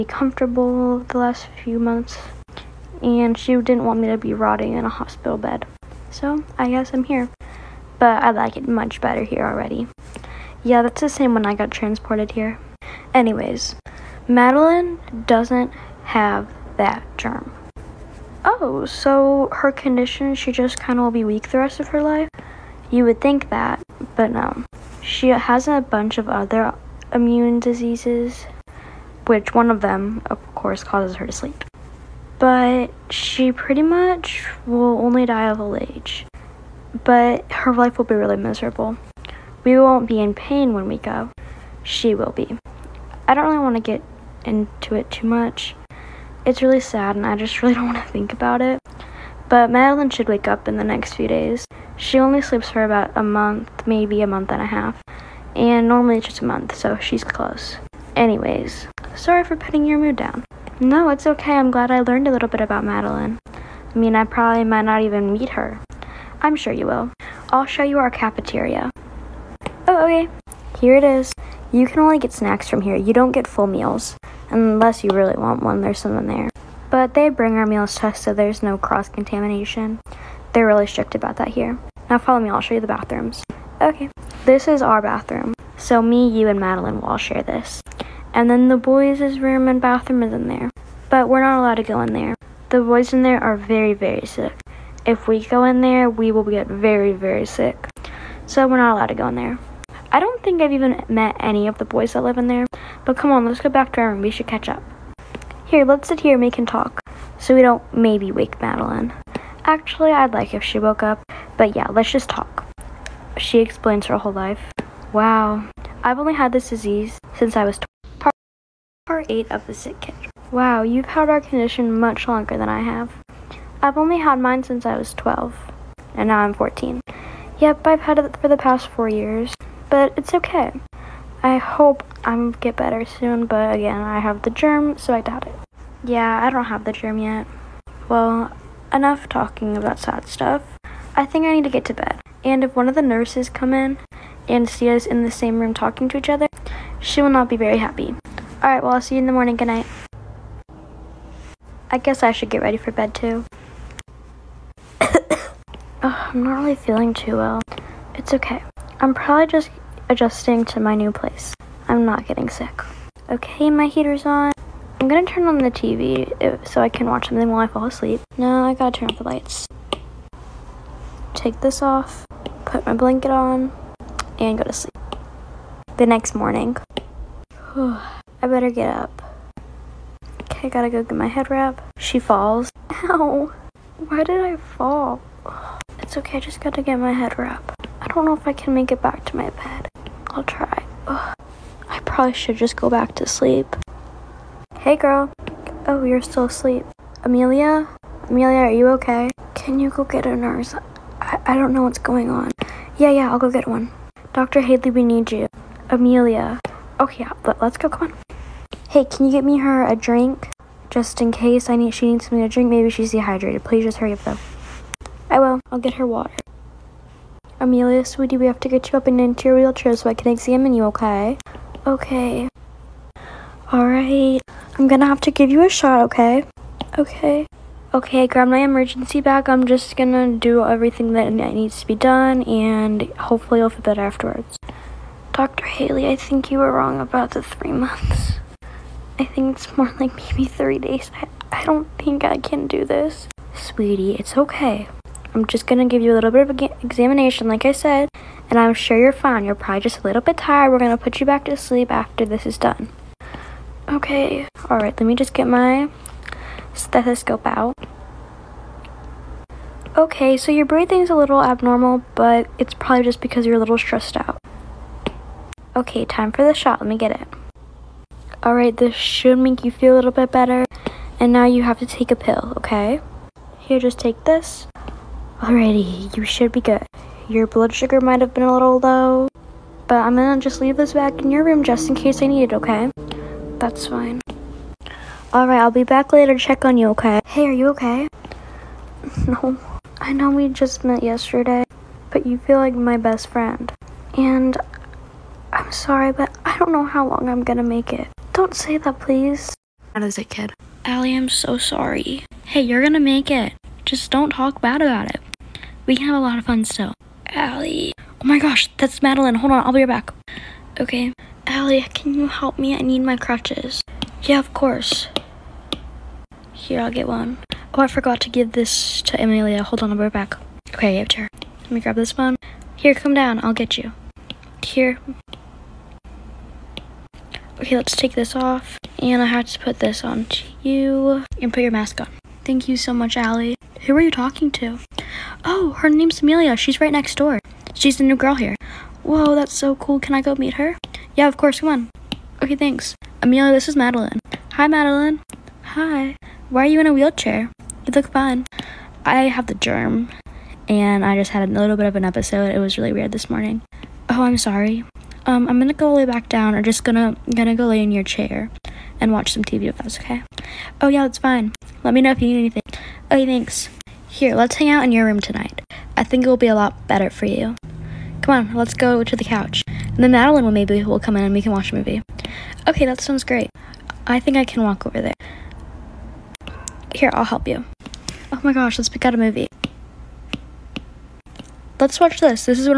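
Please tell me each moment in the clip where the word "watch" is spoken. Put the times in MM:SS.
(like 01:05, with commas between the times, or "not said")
02:47, 05:59, 06:11, 06:21.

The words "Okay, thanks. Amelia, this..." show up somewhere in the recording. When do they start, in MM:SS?
05:42.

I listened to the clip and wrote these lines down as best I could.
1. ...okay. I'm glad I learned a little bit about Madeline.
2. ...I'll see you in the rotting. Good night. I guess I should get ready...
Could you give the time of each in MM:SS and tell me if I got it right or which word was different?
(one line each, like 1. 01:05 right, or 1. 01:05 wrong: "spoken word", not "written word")
1. 01:01 right
2. 02:28 wrong: "morning", not "rotting".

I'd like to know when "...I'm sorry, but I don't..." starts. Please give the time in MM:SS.
04:55.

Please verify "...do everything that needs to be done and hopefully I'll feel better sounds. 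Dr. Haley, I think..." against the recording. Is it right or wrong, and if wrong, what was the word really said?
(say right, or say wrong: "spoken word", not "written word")
wrong: "afterwards", not "sounds".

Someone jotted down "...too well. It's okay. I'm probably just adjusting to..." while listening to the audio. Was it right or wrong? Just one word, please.
right.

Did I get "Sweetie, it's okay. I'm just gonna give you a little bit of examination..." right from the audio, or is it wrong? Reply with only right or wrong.
right.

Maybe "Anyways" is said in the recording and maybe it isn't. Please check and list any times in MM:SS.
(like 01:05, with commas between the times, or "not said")
00:13, 00:58.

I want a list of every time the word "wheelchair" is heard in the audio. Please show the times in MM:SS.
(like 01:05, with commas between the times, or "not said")
03:39, 05:46.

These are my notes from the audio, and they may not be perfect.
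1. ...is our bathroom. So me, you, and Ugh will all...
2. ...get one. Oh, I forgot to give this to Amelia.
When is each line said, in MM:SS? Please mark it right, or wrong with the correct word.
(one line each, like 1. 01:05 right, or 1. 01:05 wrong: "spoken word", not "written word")
1. 01:24 wrong: "Madeline", not "Ugh"
2. 05:16 right.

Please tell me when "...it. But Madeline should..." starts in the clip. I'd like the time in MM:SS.
00:48.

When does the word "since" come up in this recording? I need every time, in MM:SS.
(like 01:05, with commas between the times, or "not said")
01:57, 02:04.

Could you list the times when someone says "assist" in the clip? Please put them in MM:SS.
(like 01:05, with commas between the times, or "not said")
not said.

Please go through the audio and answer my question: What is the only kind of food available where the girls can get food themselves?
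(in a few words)
Snacks.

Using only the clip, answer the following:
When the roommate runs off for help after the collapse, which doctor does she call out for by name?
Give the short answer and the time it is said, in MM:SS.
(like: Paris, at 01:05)
Dr. Hadley, at 03:24.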